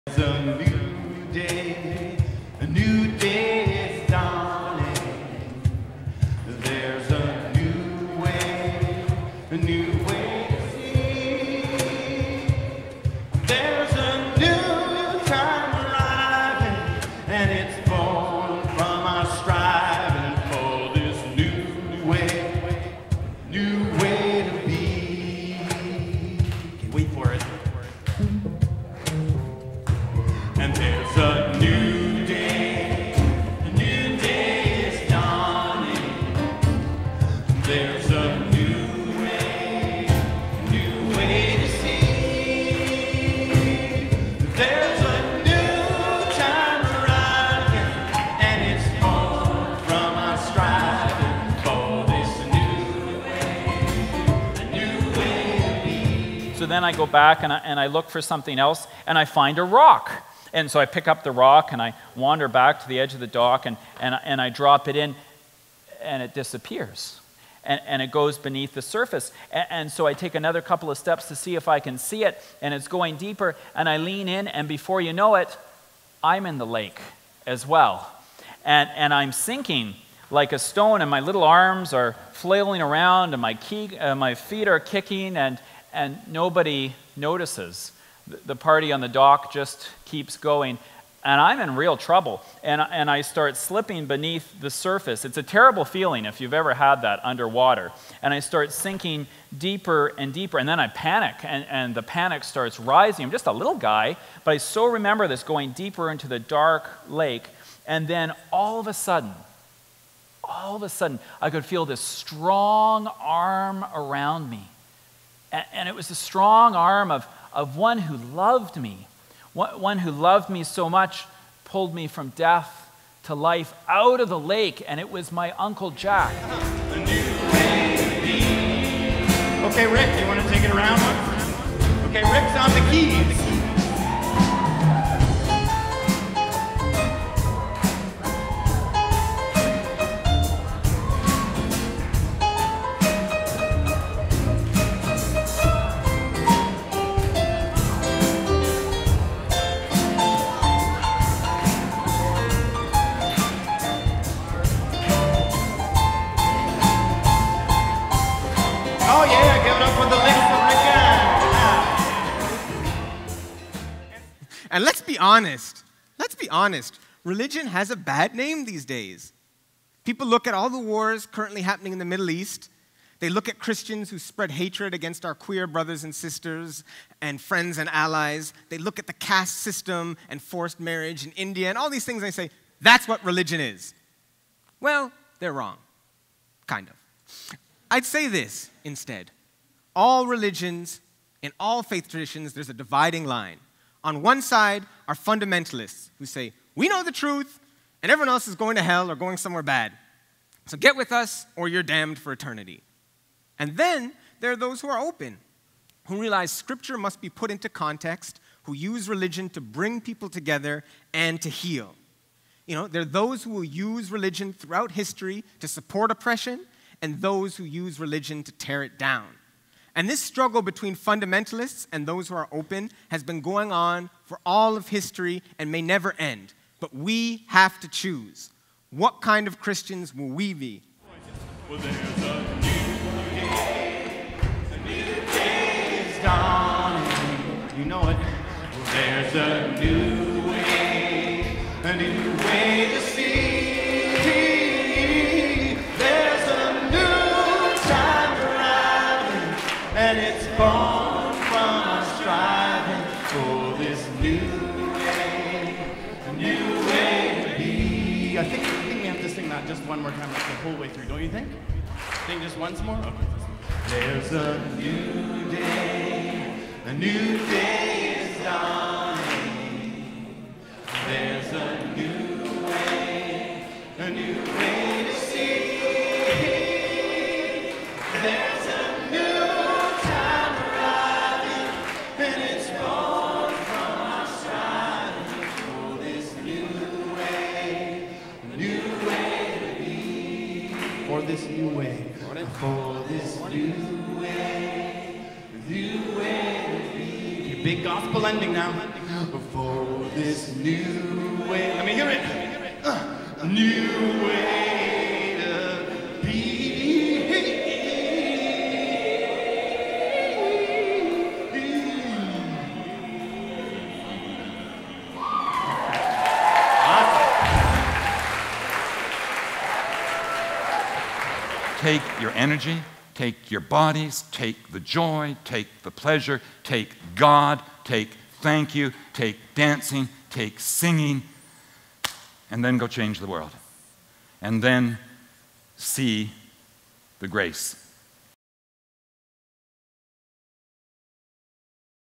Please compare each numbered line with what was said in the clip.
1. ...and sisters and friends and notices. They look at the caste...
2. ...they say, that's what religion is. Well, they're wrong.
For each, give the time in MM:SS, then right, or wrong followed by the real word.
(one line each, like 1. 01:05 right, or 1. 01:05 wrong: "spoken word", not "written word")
1. 02:56 wrong: "allies", not "notices"
2. 03:02 right.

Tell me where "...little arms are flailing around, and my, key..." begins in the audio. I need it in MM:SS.
01:21.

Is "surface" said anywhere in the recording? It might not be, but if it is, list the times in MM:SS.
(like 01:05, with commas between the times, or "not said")
01:08, 01:34.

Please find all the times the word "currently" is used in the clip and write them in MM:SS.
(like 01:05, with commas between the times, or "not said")
02:51.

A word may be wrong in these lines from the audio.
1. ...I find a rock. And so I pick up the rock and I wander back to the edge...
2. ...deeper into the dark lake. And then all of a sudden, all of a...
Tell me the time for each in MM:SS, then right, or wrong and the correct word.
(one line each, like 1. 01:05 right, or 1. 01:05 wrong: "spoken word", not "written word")
1. 00:59 right
2. 01:45 right.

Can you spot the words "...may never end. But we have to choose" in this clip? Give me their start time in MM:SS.
03:45.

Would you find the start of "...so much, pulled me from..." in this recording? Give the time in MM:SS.
02:00.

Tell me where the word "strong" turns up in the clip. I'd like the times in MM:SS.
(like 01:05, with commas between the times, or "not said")
01:52, 01:56.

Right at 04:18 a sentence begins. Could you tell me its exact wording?
I think, I think we have to sing that just one more time, like the whole way through, don't you think?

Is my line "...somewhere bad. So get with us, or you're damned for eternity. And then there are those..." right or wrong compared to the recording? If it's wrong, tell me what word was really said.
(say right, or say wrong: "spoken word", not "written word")
right.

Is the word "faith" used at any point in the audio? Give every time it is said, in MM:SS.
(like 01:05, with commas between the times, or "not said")
03:11.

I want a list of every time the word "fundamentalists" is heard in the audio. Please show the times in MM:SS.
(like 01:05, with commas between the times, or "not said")
03:15, 03:40.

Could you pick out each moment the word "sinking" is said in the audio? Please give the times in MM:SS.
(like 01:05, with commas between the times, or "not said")
01:19, 01:38.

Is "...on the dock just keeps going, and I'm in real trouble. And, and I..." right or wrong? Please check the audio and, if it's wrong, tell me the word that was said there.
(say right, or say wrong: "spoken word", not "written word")
right.